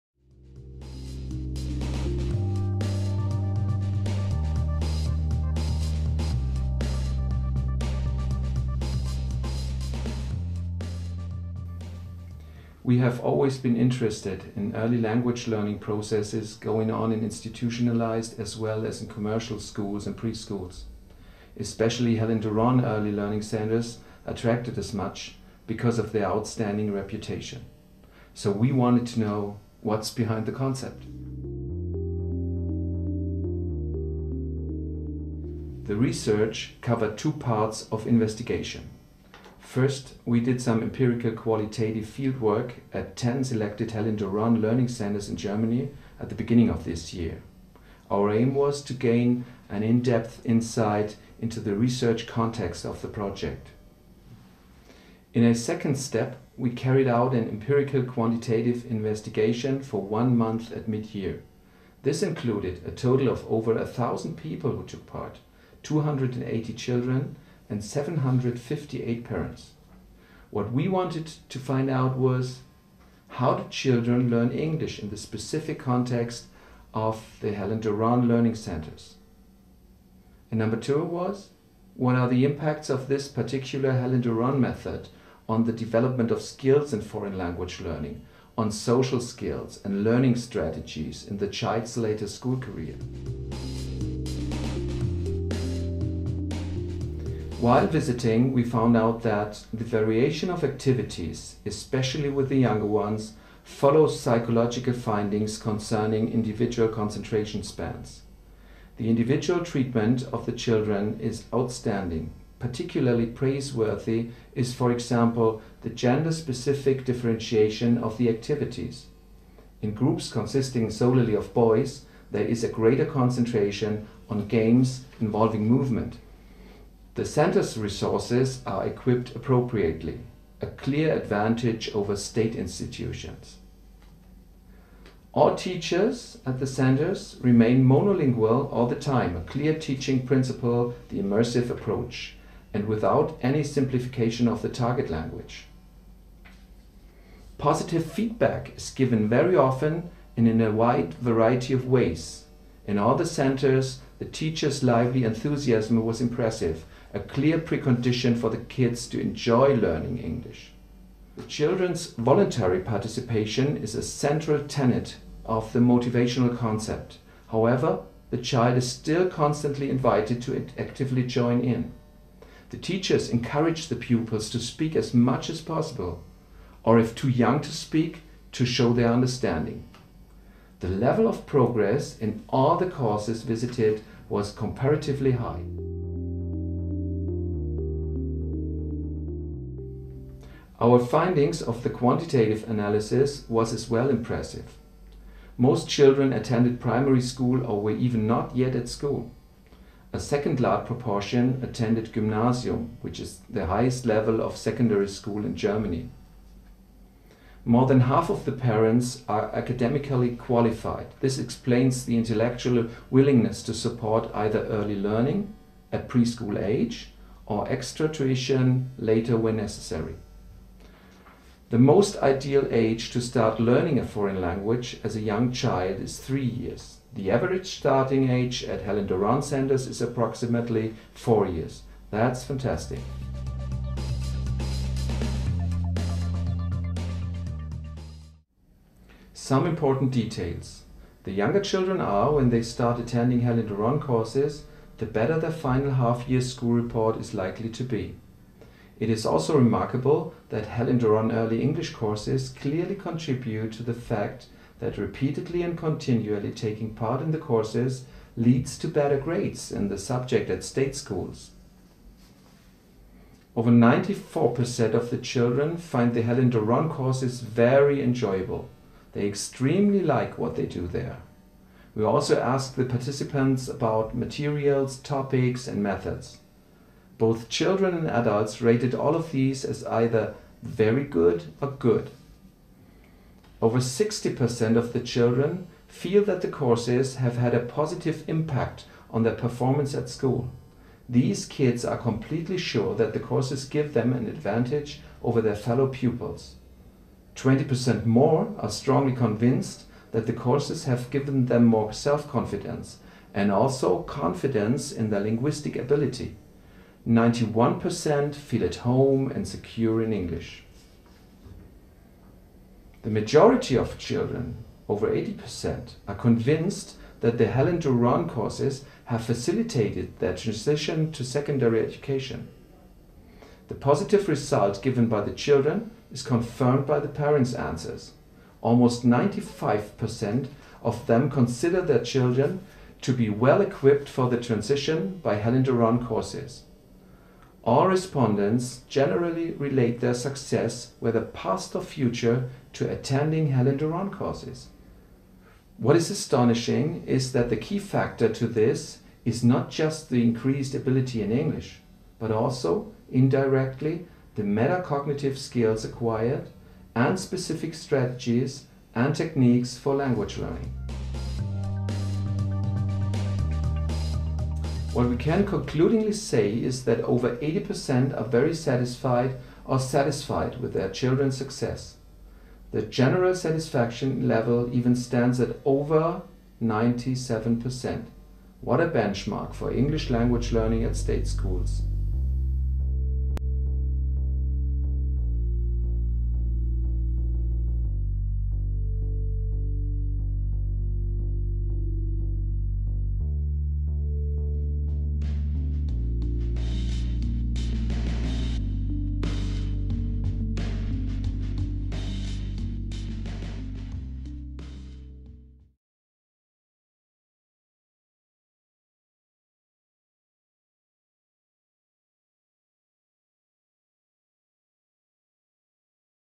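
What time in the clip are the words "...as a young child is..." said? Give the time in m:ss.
3:45.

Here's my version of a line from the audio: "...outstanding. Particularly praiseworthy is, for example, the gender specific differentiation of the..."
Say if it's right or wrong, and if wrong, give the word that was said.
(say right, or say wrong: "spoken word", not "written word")
right.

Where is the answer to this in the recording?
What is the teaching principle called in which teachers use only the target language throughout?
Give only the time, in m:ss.
2:21.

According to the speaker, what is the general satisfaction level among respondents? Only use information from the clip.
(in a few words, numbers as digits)
97%.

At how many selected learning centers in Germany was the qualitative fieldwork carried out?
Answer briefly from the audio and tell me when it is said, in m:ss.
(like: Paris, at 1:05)
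10, at 0:43.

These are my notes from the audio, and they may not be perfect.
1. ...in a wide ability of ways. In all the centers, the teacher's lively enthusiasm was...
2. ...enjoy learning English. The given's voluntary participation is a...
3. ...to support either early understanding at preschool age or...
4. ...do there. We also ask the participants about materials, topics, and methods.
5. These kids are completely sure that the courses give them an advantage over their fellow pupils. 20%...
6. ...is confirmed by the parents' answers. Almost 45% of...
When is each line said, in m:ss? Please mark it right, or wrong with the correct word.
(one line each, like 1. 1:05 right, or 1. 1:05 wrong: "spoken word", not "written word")
1. 2:30 wrong: "variety", not "ability"
2. 2:39 wrong: "children", not "given"
3. 3:33 wrong: "learning", not "understanding"
4. 4:30 right
5. 4:51 right
6. 5:26 wrong: "95", not "45".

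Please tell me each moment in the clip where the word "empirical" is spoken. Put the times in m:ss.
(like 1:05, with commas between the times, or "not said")
0:40, 0:57.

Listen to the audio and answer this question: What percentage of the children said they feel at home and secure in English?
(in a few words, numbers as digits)
91%.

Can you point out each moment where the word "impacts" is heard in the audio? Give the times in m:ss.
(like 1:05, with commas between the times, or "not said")
1:22, 4:48.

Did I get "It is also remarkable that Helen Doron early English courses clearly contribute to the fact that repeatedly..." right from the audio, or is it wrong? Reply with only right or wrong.
right.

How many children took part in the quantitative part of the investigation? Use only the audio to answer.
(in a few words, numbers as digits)
280.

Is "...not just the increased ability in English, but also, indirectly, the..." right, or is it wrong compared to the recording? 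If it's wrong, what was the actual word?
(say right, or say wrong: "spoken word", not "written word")
right.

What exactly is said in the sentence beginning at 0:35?
The research covered two parts of investigation.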